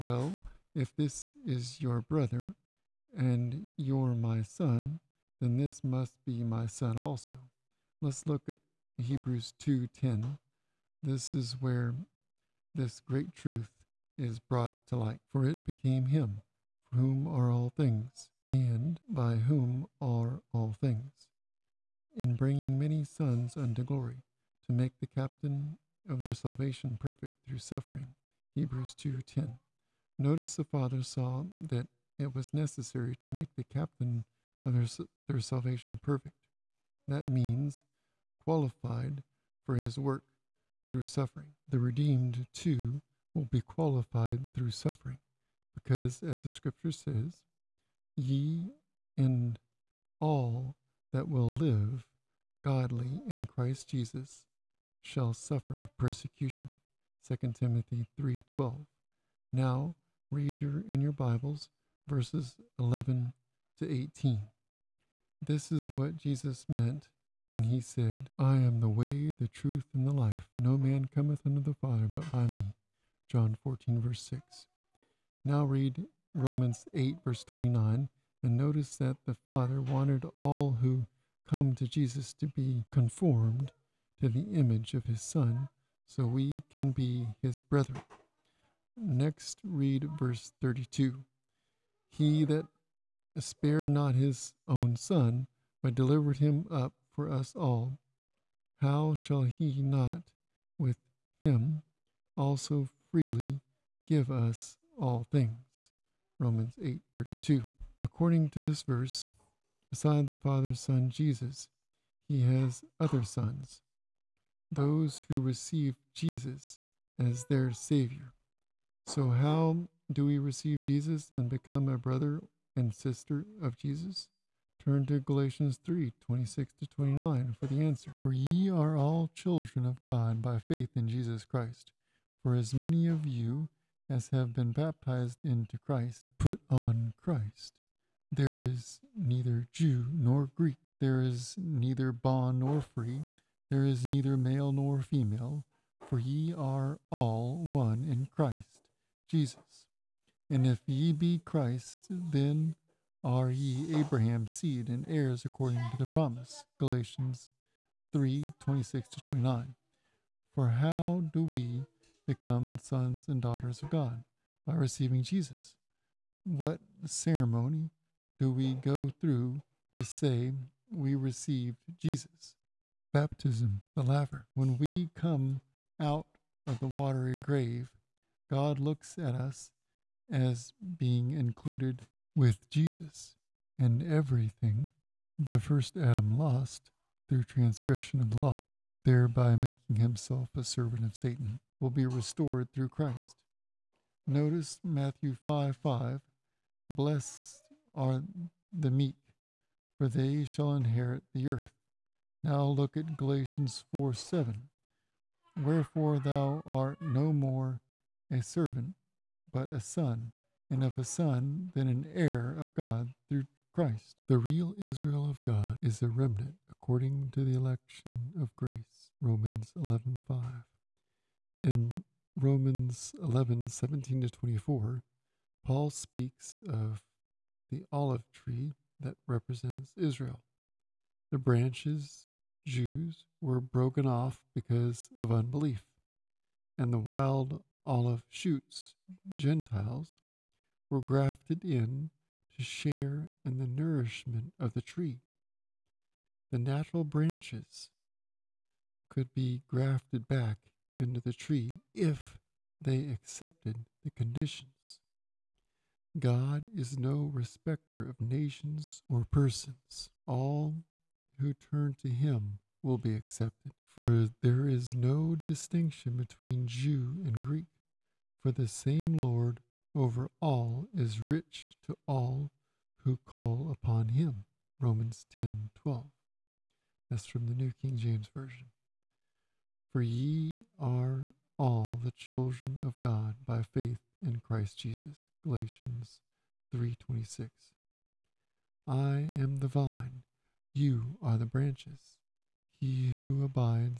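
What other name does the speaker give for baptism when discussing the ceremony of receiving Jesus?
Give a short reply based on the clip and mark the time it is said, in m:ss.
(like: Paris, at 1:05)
the laver, at 2:53.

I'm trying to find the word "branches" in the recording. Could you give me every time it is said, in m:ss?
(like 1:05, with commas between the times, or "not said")
3:51, 4:07, 4:51.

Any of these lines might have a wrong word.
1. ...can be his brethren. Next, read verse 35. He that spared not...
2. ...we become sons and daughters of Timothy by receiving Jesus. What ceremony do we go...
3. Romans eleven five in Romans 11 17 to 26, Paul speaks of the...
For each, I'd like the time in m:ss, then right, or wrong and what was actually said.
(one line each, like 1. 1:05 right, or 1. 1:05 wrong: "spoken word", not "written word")
1. 1:26 wrong: "32", not "35"
2. 2:41 wrong: "God", not "Timothy"
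3. 3:39 wrong: "24", not "26".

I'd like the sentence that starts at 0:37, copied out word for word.
That means qualified for his work through suffering.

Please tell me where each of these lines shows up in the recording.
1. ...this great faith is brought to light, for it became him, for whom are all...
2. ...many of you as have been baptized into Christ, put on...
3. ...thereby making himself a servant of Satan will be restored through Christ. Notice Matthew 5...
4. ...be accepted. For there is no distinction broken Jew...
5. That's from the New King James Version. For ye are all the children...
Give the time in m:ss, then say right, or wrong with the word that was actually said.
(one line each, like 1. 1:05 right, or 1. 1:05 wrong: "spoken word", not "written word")
1. 0:12 wrong: "truth", not "faith"
2. 2:12 right
3. 3:09 right
4. 4:22 wrong: "between", not "broken"
5. 4:37 right.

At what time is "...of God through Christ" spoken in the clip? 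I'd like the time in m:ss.
3:32.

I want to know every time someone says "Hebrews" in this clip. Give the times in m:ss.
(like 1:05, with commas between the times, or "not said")
0:09, 0:28.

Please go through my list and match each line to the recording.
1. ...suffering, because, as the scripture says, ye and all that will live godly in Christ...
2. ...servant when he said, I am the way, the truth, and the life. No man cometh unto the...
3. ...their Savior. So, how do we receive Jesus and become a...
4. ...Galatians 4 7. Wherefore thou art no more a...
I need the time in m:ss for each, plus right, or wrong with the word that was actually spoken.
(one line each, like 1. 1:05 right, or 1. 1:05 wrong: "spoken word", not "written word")
1. 0:44 right
2. 1:06 wrong: "meant", not "servant"
3. 1:57 right
4. 3:23 right.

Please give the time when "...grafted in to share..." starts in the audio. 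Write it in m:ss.
4:01.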